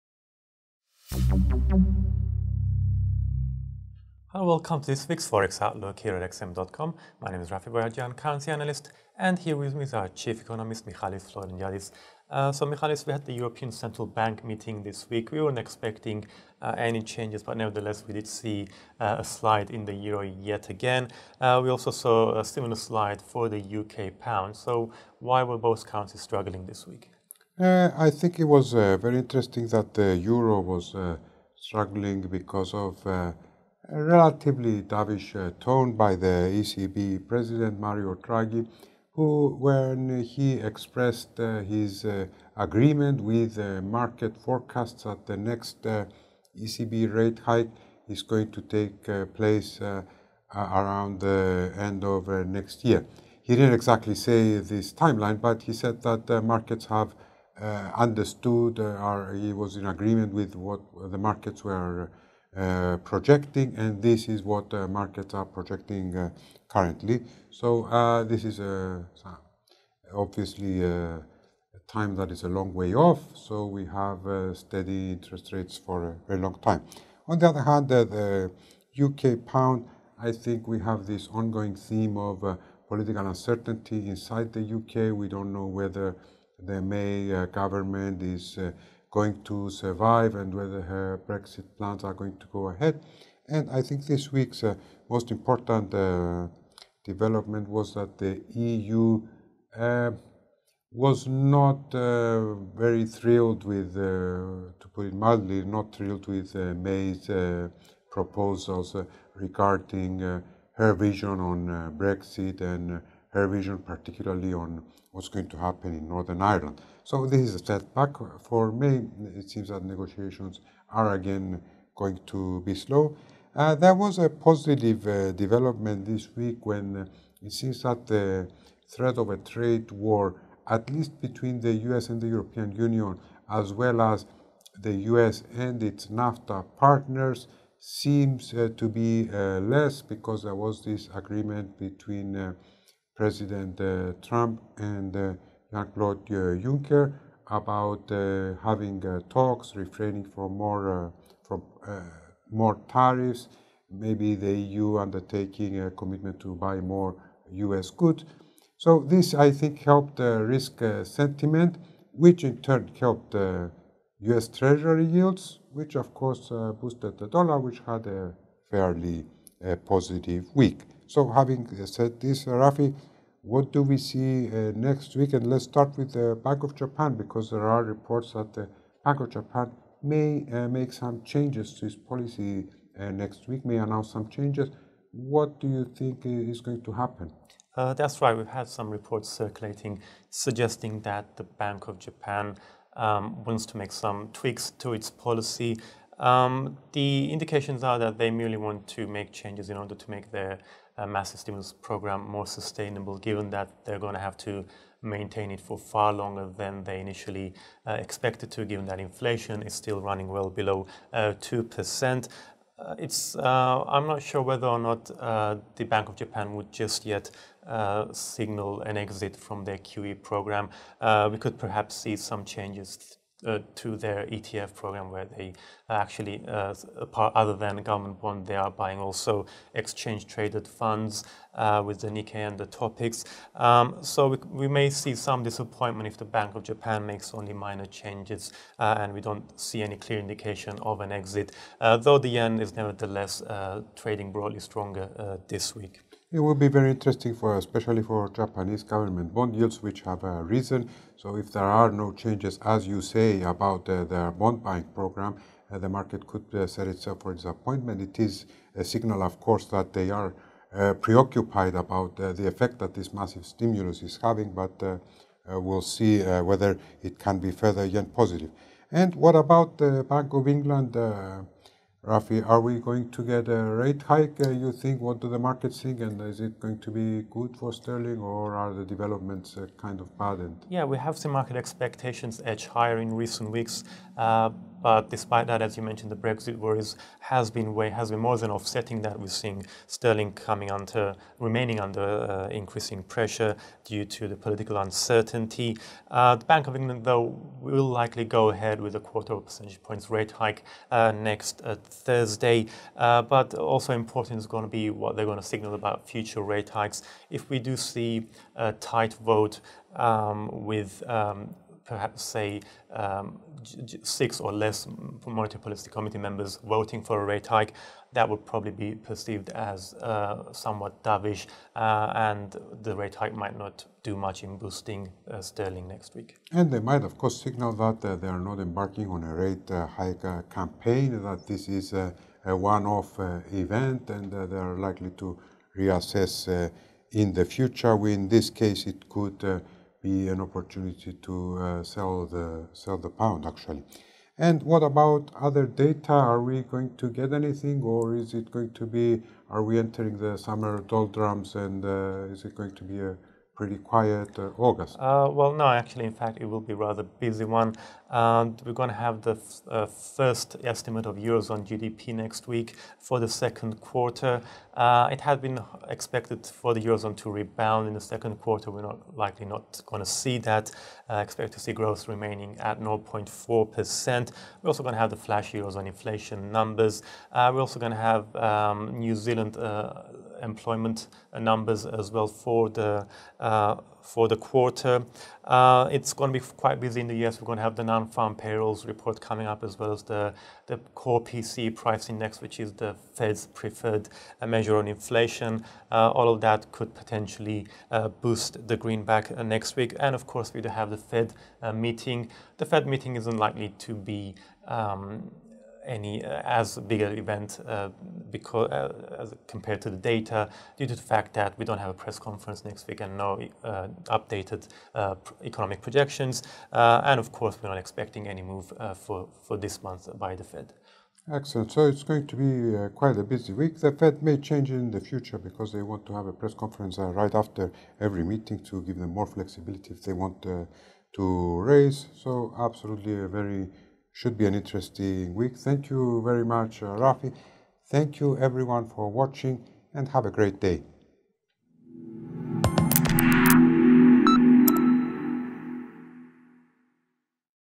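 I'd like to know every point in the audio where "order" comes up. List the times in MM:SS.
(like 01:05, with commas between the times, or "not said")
03:19.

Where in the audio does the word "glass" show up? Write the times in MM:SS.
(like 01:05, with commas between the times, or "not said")
not said.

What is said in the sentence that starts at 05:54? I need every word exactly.
Uh, well, no, actually, in fact, it will be rather busy one.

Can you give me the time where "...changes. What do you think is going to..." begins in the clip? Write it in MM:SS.
03:04.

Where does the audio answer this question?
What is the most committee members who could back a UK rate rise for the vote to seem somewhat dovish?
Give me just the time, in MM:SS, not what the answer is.
05:14.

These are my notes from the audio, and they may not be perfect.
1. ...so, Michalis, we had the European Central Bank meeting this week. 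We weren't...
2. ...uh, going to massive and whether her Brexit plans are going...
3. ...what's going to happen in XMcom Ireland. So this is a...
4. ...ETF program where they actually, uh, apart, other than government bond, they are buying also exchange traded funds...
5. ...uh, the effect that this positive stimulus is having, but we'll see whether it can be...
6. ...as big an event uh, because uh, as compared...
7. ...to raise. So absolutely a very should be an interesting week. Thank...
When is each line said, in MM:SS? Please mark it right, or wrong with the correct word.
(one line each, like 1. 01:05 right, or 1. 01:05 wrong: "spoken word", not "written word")
1. 00:12 right
2. 01:28 wrong: "survive", not "massive"
3. 01:55 wrong: "Northern", not "XMcom"
4. 03:44 right
5. 04:22 wrong: "massive", not "positive"
6. 06:46 right
7. 07:11 right.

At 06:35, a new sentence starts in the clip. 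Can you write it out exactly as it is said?
Uh, all of that could potentially uh, boost the greenback uh, next week.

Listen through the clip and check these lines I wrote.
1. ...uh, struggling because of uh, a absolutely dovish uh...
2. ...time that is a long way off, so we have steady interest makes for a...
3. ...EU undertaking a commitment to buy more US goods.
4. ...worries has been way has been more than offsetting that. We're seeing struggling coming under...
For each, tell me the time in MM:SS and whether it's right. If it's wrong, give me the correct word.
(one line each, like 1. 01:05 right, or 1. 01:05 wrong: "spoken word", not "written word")
1. 00:30 wrong: "relatively", not "absolutely"
2. 01:11 wrong: "rates", not "makes"
3. 02:34 right
4. 04:46 wrong: "sterling", not "struggling".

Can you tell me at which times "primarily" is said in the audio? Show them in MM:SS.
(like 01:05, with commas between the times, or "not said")
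not said.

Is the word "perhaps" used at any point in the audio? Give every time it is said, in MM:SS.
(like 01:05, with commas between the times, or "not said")
03:41, 05:11.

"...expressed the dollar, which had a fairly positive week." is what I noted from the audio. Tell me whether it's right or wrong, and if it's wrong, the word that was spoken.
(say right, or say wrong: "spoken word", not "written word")
wrong: "boosted", not "expressed".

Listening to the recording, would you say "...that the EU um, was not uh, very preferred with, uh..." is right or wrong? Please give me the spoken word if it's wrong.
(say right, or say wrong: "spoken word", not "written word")
wrong: "thrilled", not "preferred".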